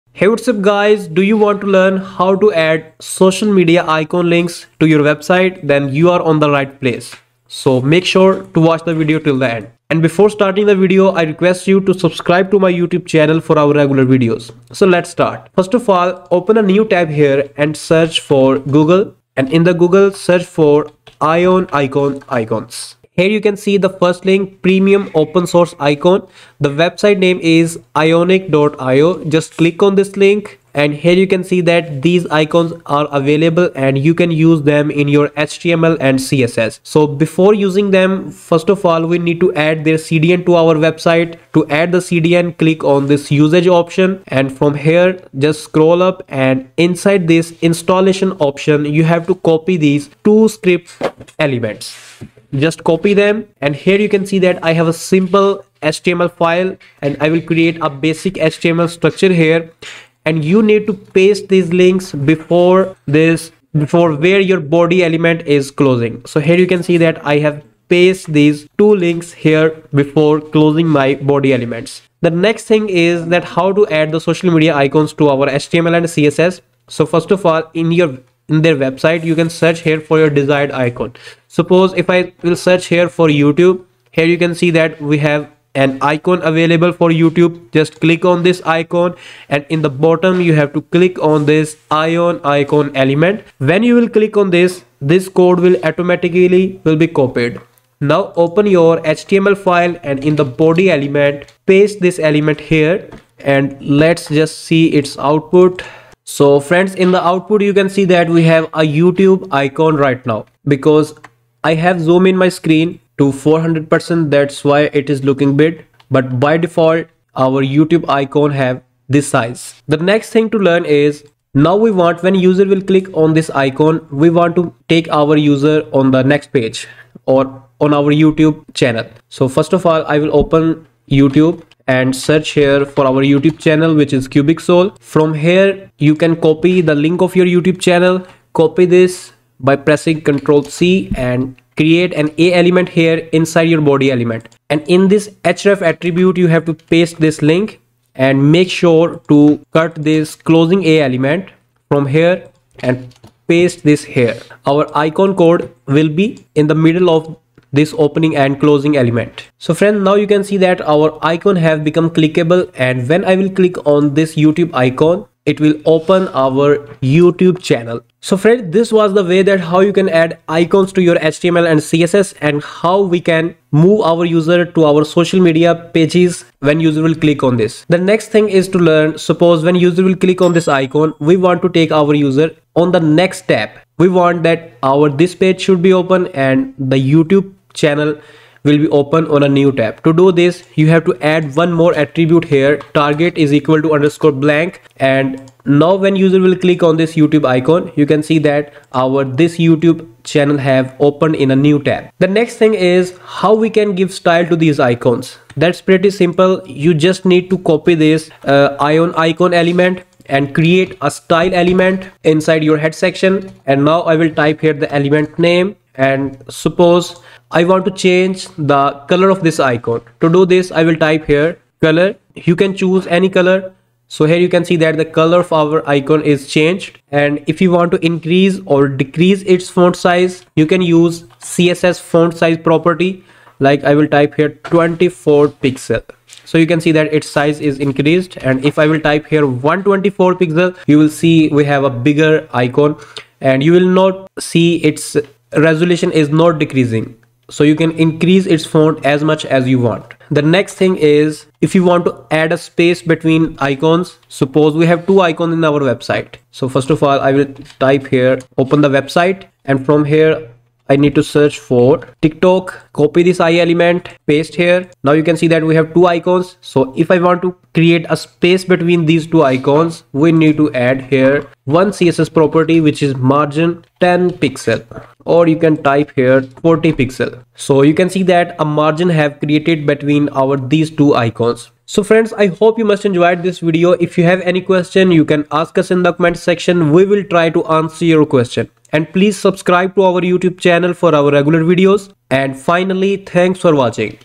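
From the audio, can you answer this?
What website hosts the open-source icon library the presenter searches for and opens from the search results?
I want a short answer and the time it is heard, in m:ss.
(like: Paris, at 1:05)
ionic.io, at 0:27.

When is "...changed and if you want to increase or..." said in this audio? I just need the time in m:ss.
3:46.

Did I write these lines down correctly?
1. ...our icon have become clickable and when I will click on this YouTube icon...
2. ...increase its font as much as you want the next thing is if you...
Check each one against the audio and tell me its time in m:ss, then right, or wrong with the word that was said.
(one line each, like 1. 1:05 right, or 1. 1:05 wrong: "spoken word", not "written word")
1. 2:40 right
2. 4:07 right.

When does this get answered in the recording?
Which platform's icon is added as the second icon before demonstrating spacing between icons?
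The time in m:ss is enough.
4:22.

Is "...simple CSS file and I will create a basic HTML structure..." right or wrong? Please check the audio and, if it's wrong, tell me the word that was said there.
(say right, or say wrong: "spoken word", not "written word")
wrong: "HTML", not "CSS".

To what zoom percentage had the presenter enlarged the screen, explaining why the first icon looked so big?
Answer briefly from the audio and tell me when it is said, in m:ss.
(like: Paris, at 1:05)
400%, at 1:53.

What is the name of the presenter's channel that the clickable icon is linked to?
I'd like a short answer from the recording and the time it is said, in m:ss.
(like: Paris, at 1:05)
CubixSol, at 2:14.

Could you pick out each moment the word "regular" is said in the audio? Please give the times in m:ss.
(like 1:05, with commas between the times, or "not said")
0:13, 4:51.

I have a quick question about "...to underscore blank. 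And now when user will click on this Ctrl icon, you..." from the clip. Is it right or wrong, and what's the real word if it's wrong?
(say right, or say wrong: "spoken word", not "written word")
wrong: "YouTube", not "Ctrl".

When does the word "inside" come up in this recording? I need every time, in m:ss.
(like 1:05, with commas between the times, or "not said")
0:46, 2:23, 3:32.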